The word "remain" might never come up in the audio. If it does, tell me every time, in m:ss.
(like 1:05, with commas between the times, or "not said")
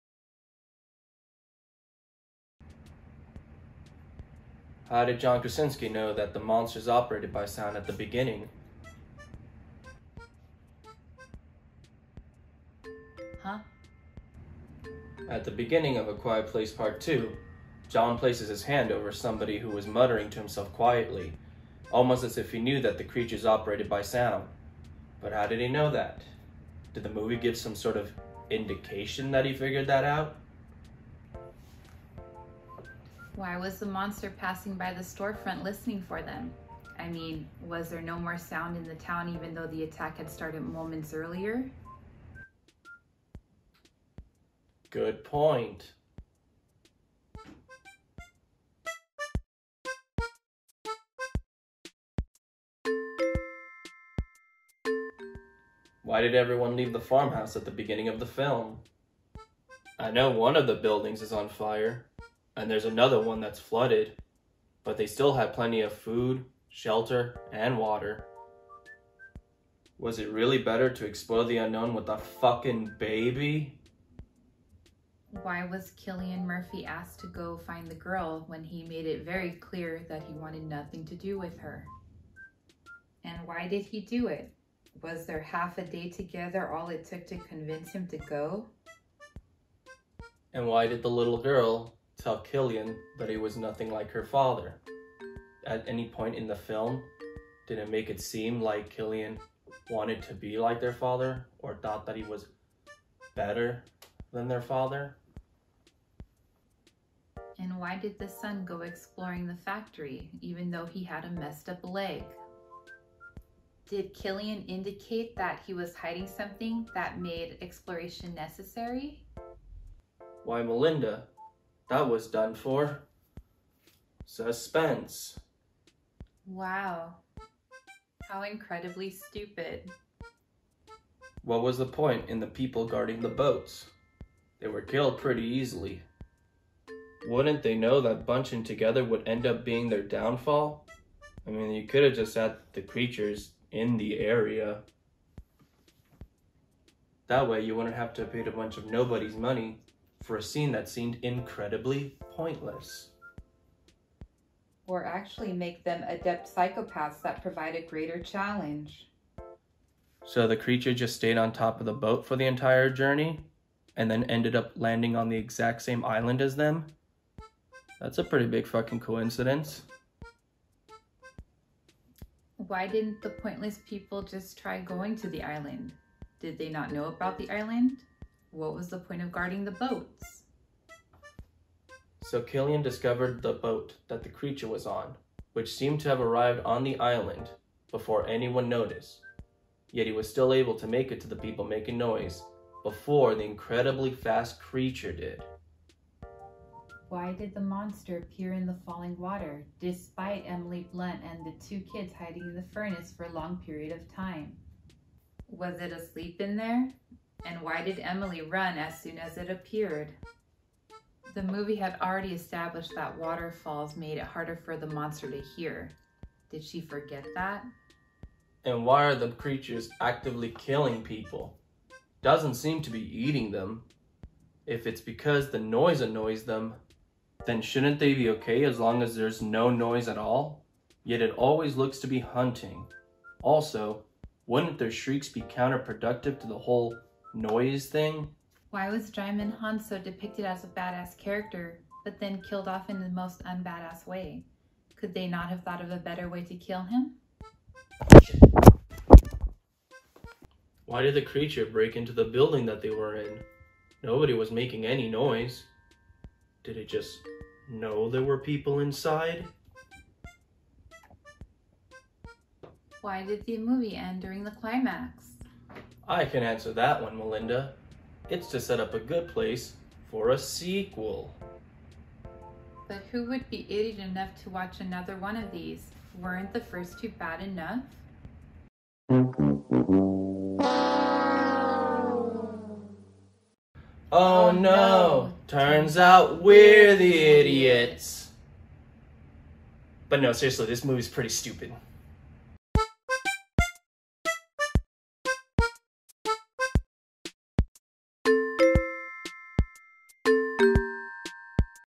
not said.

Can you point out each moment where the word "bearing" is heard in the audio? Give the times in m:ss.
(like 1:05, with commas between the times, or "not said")
not said.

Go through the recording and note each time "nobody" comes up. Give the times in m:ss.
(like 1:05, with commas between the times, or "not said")
2:28, 4:14.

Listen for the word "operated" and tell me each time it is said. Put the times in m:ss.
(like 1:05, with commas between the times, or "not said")
0:06, 0:23.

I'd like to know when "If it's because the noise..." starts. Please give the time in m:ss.
3:44.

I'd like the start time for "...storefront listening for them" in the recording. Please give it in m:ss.
0:35.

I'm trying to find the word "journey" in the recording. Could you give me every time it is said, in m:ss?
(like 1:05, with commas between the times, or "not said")
2:42.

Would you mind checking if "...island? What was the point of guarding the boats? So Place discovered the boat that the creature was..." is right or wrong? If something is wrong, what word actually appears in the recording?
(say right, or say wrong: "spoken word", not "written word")
wrong: "Cillian", not "Place".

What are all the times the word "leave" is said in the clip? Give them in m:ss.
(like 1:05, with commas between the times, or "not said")
0:56.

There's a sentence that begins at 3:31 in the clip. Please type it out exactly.
The movie had already established that waterfalls made it harder for the monster to hear.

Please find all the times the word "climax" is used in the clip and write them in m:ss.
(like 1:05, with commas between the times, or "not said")
4:24.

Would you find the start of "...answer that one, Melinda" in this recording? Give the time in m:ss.
4:26.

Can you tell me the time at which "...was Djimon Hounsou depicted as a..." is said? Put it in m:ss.
3:58.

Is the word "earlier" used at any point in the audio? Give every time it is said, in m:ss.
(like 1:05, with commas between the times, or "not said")
0:41.